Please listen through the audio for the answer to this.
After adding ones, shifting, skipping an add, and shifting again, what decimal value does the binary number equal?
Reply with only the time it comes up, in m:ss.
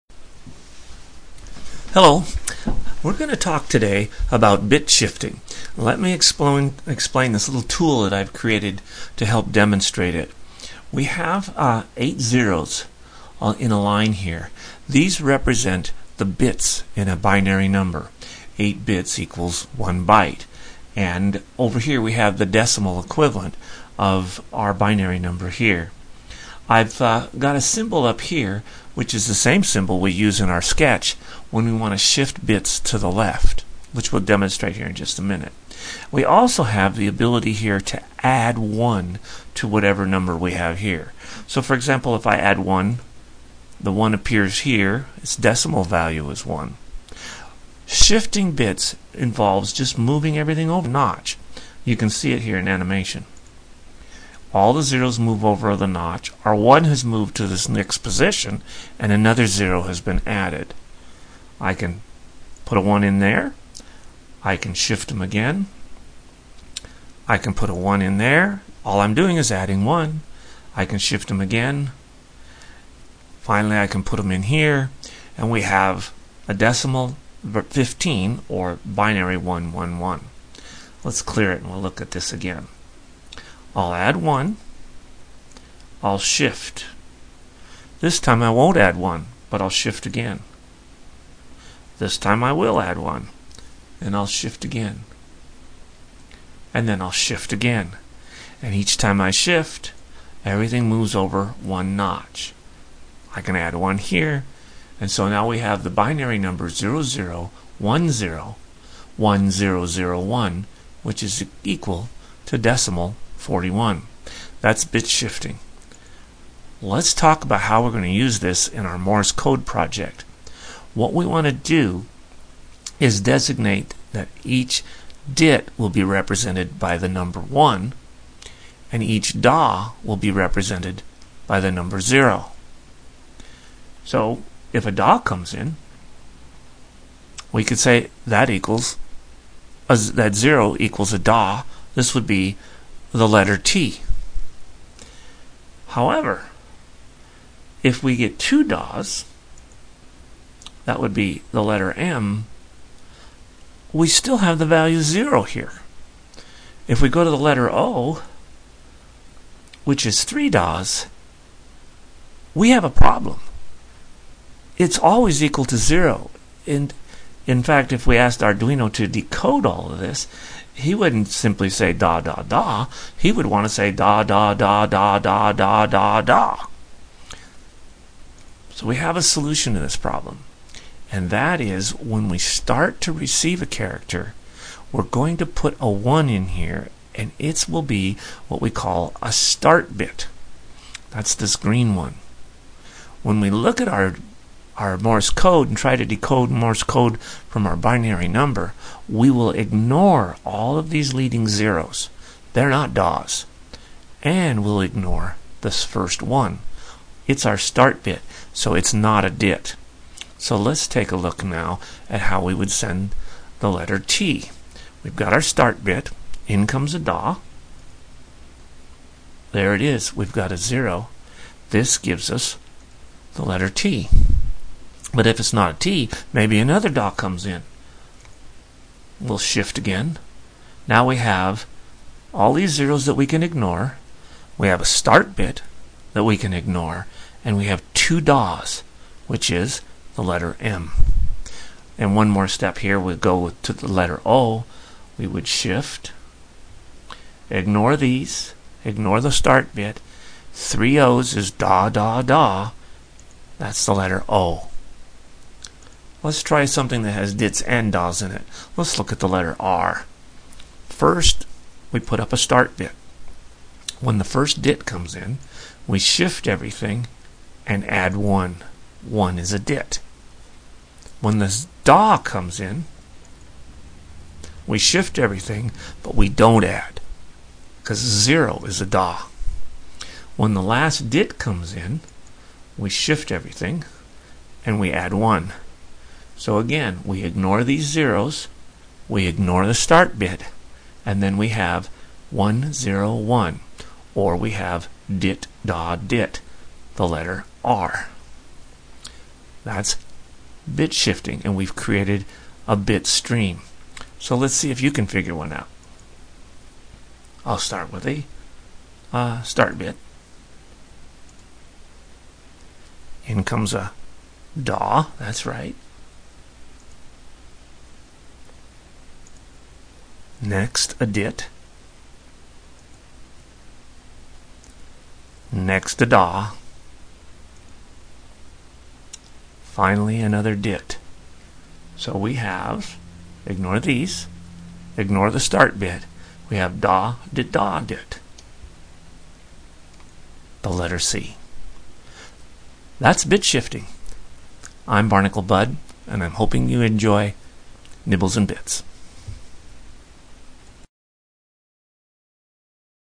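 1:52.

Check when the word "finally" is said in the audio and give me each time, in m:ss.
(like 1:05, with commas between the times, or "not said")
1:13, 5:29.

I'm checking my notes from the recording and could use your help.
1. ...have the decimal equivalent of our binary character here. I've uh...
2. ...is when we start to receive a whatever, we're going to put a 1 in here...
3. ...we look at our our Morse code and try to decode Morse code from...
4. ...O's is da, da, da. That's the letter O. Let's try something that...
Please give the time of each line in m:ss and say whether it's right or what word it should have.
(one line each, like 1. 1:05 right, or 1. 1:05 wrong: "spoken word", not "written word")
1. 0:22 wrong: "number", not "character"
2. 3:01 wrong: "character", not "whatever"
3. 3:13 right
4. 4:10 right.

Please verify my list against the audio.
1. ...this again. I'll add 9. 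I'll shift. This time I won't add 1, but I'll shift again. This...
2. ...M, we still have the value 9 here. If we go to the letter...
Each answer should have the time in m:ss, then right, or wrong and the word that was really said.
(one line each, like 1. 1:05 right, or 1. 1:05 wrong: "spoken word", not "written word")
1. 1:22 wrong: "1", not "9"
2. 2:31 wrong: "0", not "9".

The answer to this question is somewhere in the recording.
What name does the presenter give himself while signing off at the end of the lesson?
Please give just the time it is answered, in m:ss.
5:45.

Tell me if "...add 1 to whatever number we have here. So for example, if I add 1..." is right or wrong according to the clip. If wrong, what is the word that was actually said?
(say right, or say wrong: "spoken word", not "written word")
right.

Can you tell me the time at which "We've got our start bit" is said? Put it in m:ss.
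3:35.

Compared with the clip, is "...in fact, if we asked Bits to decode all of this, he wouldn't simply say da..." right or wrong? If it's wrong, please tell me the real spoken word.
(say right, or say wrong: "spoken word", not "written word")
wrong: "Arduino", not "Bits".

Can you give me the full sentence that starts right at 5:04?
So let's see if you can figure one out.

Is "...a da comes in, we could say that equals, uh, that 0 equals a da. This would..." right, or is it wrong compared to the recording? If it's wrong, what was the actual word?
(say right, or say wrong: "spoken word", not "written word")
right.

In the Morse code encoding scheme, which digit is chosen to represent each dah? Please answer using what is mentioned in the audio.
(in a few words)
0.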